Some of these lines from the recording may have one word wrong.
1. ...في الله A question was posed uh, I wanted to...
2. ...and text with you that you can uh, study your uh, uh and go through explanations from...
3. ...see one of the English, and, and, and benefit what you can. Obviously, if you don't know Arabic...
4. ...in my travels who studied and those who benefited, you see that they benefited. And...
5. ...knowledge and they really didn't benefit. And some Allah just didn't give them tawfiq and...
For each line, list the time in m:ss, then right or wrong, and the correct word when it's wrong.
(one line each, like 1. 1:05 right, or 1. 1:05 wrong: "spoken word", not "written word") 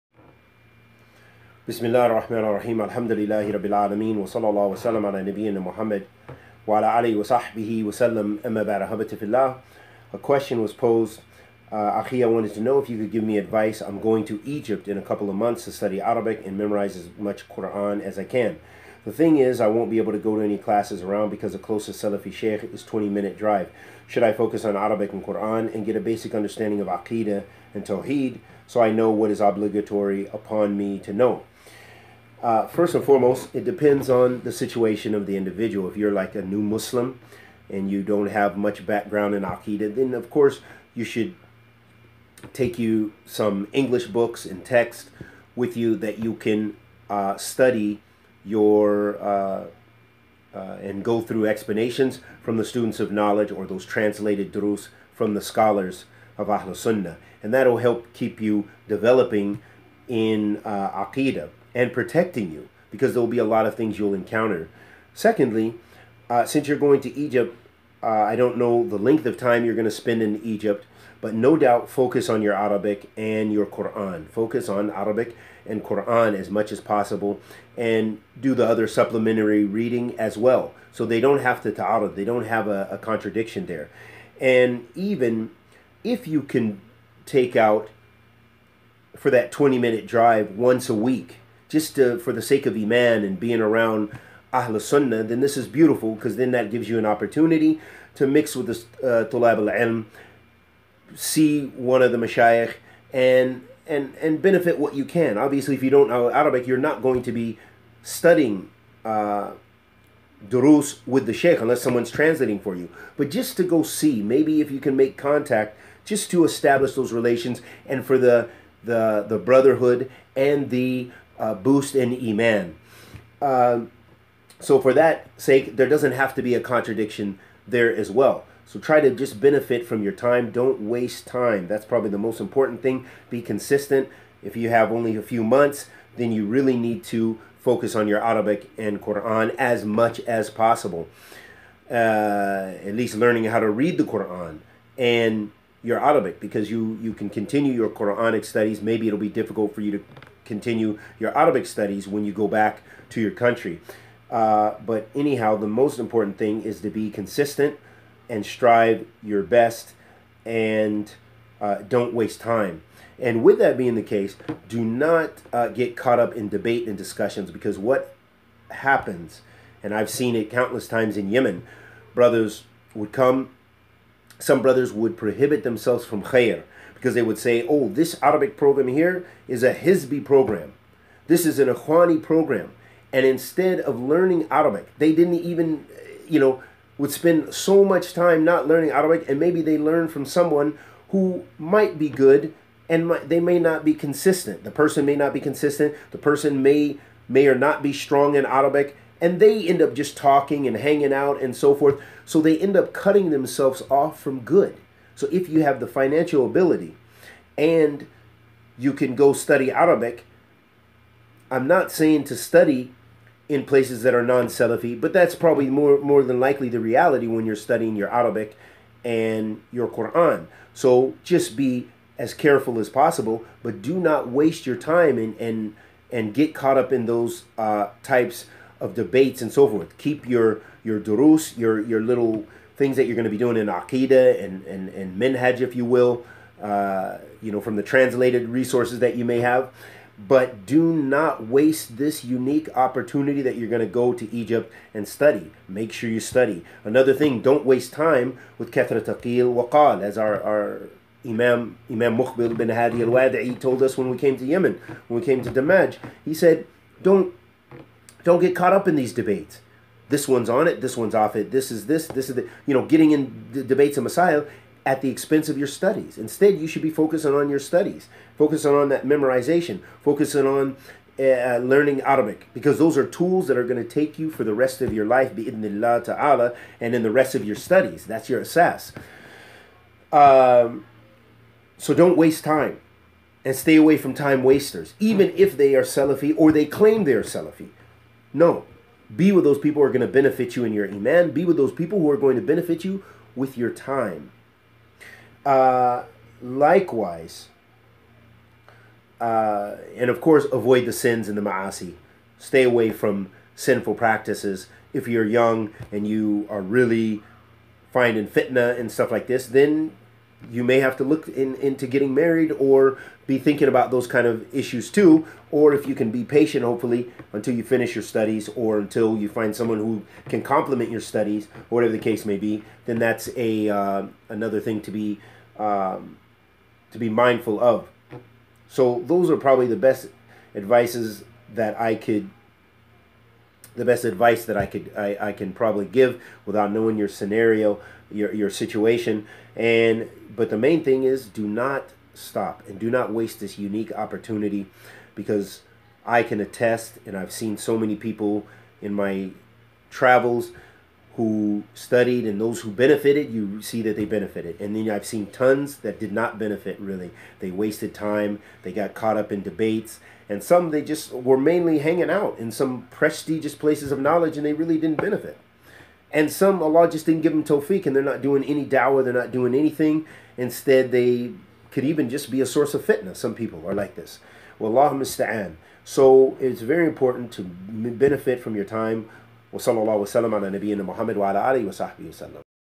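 1. 0:09 right
2. 0:44 right
3. 1:41 wrong: "Mashayikh", not "English"
4. 5:48 right
5. 6:03 right.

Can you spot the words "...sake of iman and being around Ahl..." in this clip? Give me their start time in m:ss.
1:32.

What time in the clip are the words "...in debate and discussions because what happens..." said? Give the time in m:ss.
2:46.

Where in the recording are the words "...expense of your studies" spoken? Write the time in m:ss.
4:25.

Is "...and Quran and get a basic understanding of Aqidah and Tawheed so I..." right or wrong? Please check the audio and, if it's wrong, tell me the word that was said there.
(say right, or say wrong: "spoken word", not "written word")
right.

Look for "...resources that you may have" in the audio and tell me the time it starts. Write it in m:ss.
3:58.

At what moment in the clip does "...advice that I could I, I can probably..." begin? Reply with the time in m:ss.
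5:34.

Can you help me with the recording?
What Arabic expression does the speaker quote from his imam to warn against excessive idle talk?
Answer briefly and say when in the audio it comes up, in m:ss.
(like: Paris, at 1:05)
Kethra Taqil Waqal, at 4:08.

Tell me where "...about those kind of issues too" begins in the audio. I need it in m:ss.
5:13.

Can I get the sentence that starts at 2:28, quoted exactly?
Maybe it'll be difficult for you to continue your Arabic studies when you go back to your country.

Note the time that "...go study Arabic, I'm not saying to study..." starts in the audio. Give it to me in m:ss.
3:29.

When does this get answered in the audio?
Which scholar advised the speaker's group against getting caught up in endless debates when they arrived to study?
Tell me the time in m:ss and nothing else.
4:12.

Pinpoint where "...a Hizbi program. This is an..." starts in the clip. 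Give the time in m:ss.
2:59.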